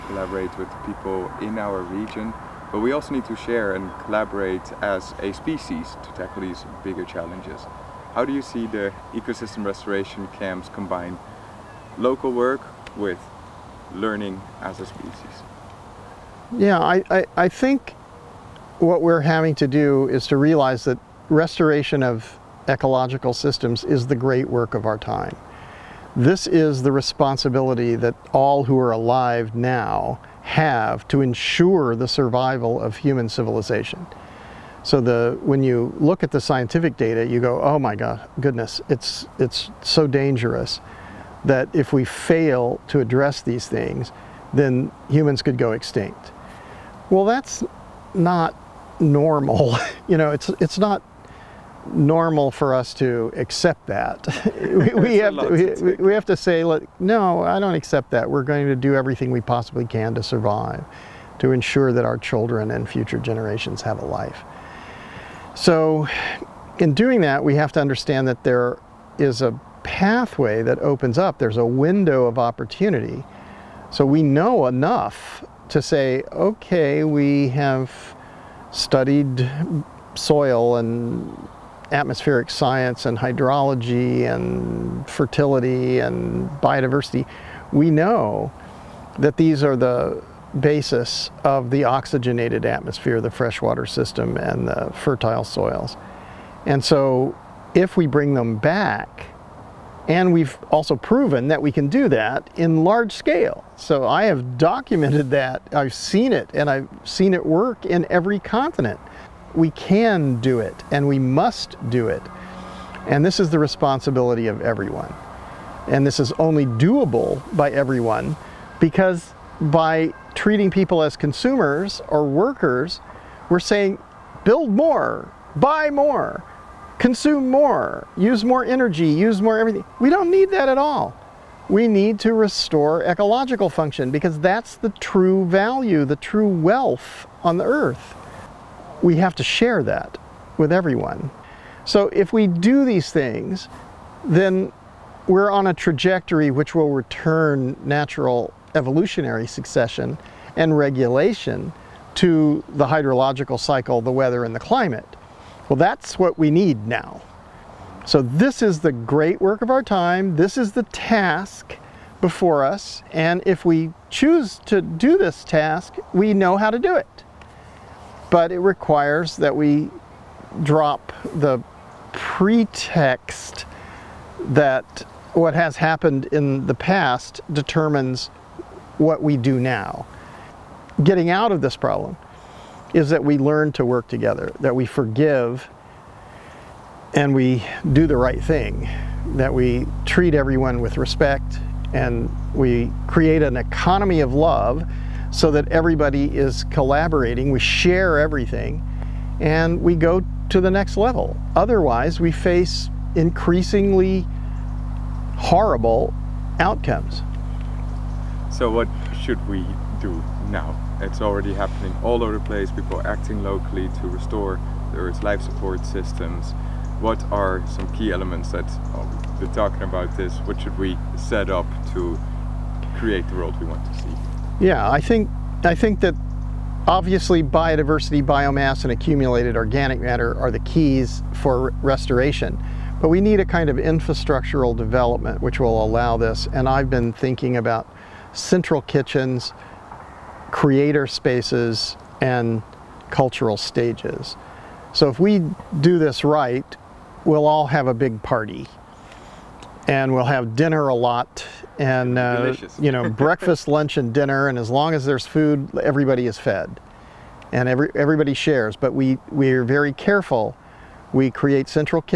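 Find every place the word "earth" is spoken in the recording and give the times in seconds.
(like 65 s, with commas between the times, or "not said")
137 s, 214 s.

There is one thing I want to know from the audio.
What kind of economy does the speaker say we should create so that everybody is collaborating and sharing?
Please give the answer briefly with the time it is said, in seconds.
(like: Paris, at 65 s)
An economy of love, at 193 s.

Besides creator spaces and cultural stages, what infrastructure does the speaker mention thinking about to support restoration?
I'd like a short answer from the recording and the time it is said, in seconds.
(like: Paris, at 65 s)
Central kitchens, at 238 s.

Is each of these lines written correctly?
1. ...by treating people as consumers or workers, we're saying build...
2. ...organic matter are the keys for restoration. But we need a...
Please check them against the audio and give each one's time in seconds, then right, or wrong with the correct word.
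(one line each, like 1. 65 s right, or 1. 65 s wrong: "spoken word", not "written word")
1. 119 s right
2. 229 s right.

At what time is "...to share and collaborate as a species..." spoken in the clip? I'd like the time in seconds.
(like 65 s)
3 s.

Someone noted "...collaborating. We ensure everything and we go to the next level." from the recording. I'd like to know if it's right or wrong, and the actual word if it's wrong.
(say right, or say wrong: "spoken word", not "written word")
wrong: "share", not "ensure".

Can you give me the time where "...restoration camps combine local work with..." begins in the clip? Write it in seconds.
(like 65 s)
9 s.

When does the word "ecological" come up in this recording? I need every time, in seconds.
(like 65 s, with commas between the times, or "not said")
22 s, 133 s.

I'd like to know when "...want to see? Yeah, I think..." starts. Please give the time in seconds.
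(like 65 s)
223 s.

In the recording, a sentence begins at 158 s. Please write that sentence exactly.
So this is the great work of our time.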